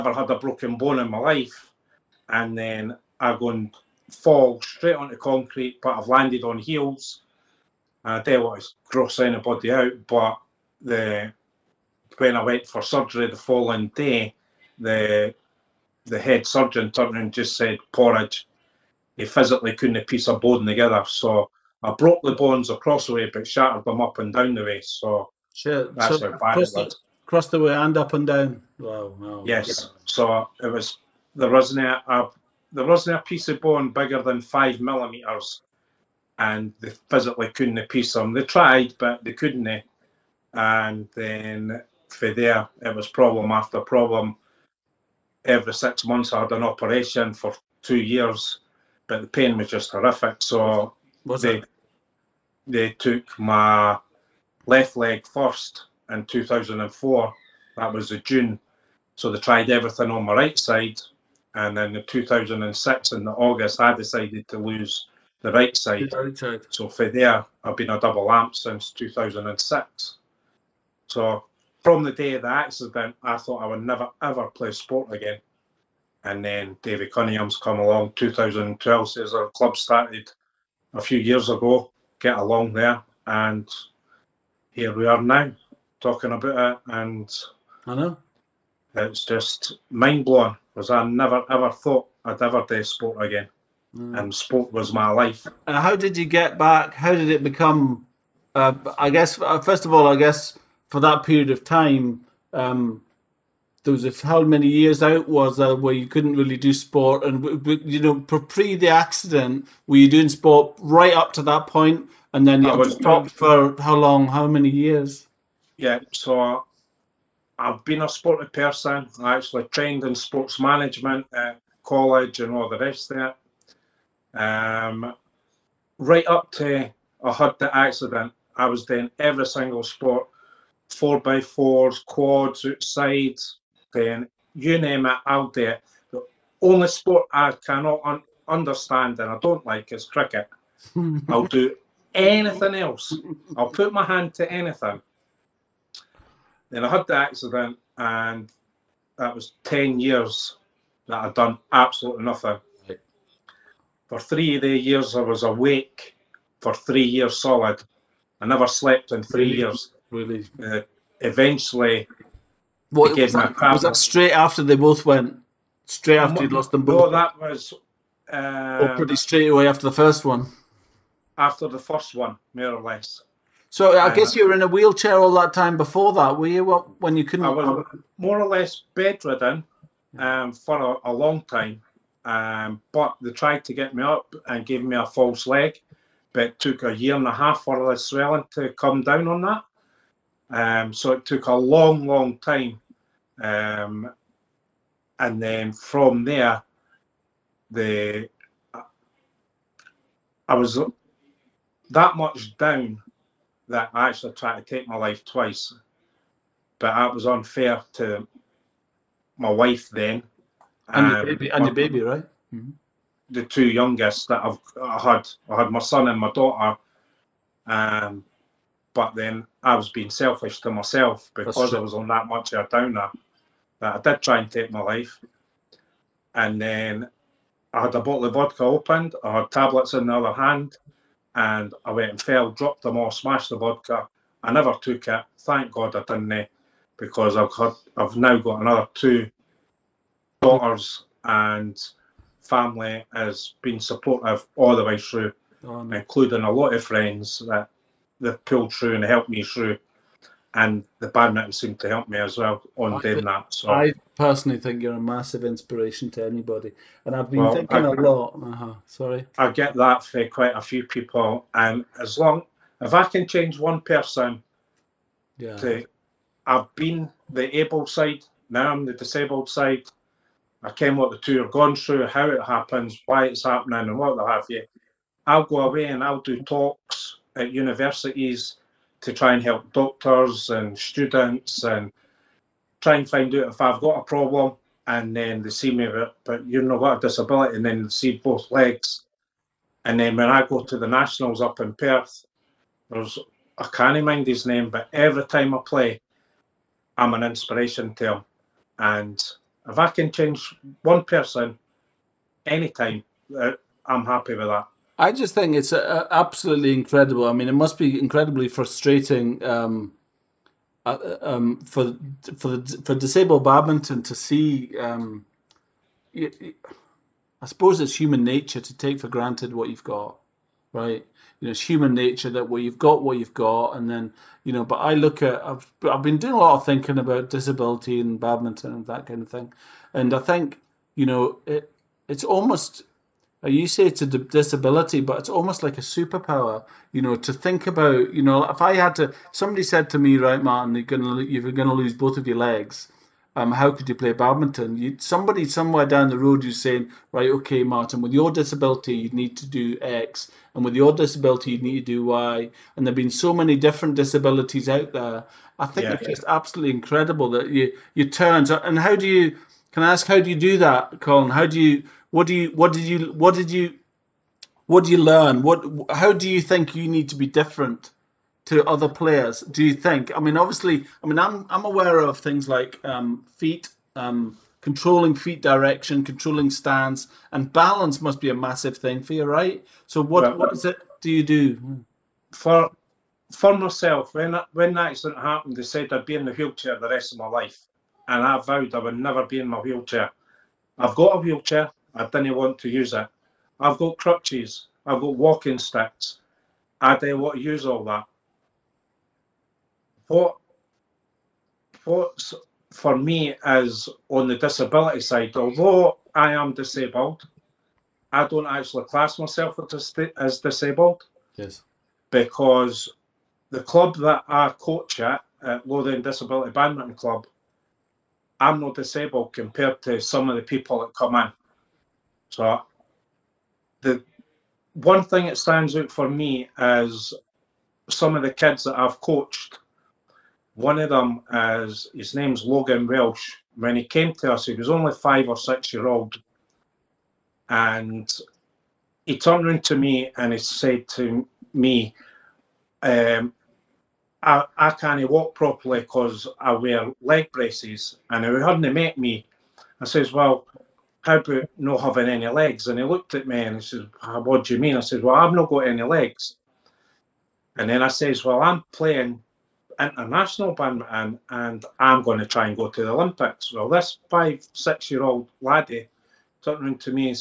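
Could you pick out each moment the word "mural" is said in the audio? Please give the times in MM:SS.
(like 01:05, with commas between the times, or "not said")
not said.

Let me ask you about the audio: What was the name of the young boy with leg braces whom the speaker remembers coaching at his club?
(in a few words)
Logan Welsh.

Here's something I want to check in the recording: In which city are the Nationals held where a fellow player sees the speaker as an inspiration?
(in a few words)
Perth.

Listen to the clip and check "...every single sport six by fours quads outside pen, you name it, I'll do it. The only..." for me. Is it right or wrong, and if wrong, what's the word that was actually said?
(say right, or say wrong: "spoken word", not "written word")
wrong: "four", not "six".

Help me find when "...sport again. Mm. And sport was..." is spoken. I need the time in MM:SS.
01:32.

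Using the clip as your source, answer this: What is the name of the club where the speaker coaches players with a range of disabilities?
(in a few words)
Lothian Disability Badminton Club.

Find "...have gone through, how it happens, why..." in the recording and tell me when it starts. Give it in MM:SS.
04:31.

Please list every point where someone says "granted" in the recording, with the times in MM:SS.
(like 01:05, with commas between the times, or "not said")
05:19.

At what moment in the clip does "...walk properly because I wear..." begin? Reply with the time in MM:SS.
07:25.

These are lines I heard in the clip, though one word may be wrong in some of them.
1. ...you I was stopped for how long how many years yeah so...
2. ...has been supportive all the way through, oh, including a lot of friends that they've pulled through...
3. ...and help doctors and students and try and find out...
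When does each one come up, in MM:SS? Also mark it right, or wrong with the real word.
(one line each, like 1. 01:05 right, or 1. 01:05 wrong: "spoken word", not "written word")
1. 01:52 right
2. 04:03 right
3. 04:39 right.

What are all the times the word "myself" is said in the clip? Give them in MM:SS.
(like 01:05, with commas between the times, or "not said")
03:40, 06:23, 06:49.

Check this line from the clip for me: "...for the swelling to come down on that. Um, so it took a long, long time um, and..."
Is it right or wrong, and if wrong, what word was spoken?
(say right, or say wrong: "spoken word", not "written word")
right.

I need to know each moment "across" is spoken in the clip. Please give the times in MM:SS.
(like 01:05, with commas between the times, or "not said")
00:22, 00:27.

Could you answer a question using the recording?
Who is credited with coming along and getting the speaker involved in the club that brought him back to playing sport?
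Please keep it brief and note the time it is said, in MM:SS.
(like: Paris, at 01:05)
David Cunningham, at 01:16.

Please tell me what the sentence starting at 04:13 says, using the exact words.
So I personally think you're a massive inspiration to anybody, and I've been well, thinking I, a lot.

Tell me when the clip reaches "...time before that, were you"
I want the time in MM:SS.
02:55.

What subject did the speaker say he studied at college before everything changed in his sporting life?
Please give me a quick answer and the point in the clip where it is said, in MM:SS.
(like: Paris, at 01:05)
Sports management, at 02:00.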